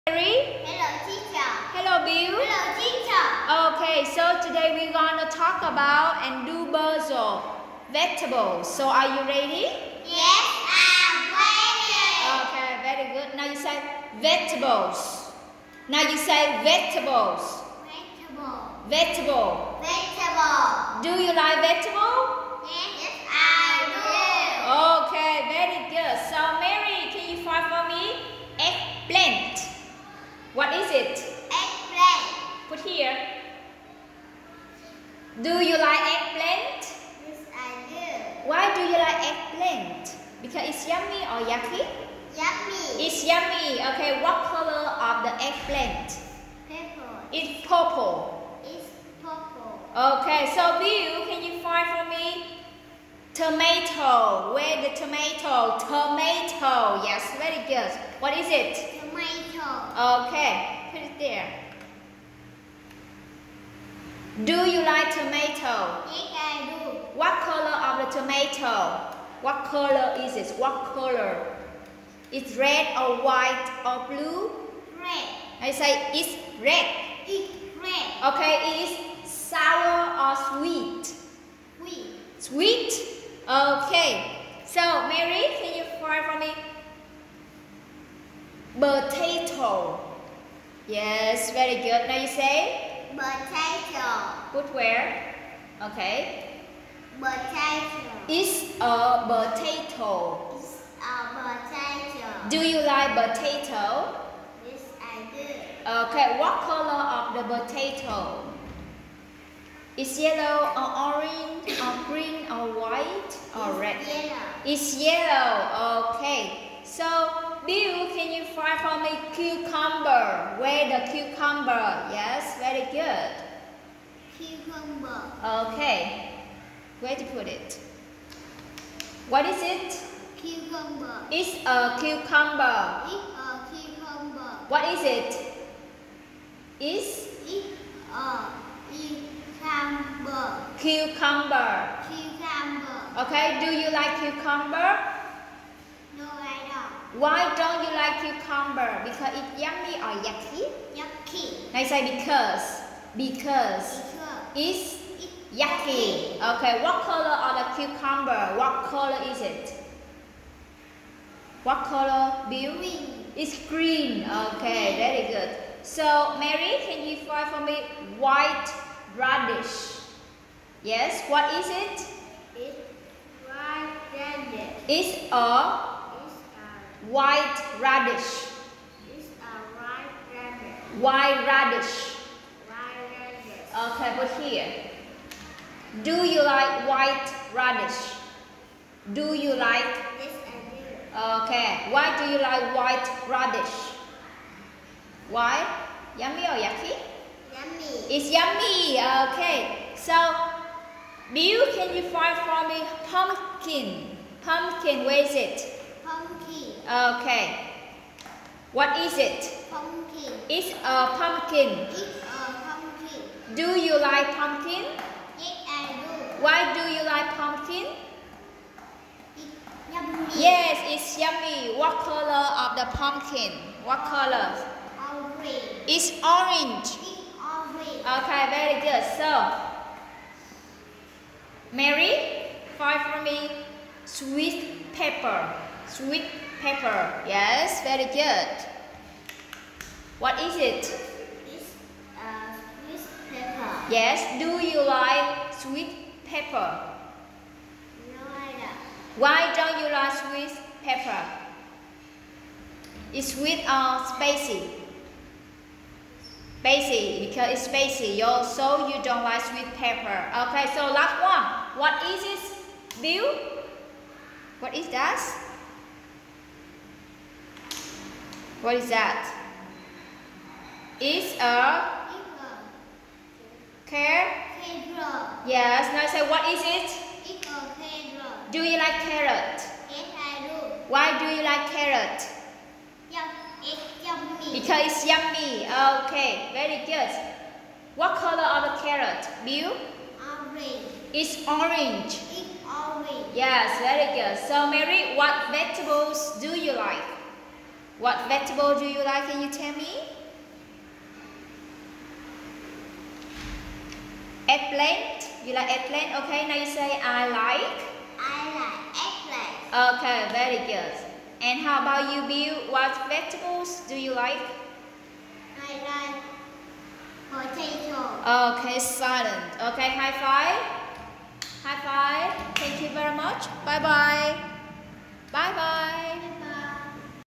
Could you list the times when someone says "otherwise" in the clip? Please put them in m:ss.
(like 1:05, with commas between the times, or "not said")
not said.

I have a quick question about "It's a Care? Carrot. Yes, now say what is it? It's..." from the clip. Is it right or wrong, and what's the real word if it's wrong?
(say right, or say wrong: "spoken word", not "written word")
right.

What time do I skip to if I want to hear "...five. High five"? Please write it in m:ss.
5:20.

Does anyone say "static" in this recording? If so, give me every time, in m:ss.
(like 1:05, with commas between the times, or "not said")
not said.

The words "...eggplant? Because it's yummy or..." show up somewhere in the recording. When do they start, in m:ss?
0:39.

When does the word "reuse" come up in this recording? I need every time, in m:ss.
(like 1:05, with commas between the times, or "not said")
not said.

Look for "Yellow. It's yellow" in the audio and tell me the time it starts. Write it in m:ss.
1:54.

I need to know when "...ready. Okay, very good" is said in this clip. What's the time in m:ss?
0:11.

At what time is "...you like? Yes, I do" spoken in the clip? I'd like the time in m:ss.
3:09.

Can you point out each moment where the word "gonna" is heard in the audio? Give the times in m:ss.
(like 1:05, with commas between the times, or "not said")
0:04.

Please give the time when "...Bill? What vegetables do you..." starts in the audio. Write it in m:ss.
5:12.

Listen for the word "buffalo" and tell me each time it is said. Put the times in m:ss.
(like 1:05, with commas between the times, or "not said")
not said.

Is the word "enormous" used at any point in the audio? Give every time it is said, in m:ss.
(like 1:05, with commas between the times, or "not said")
not said.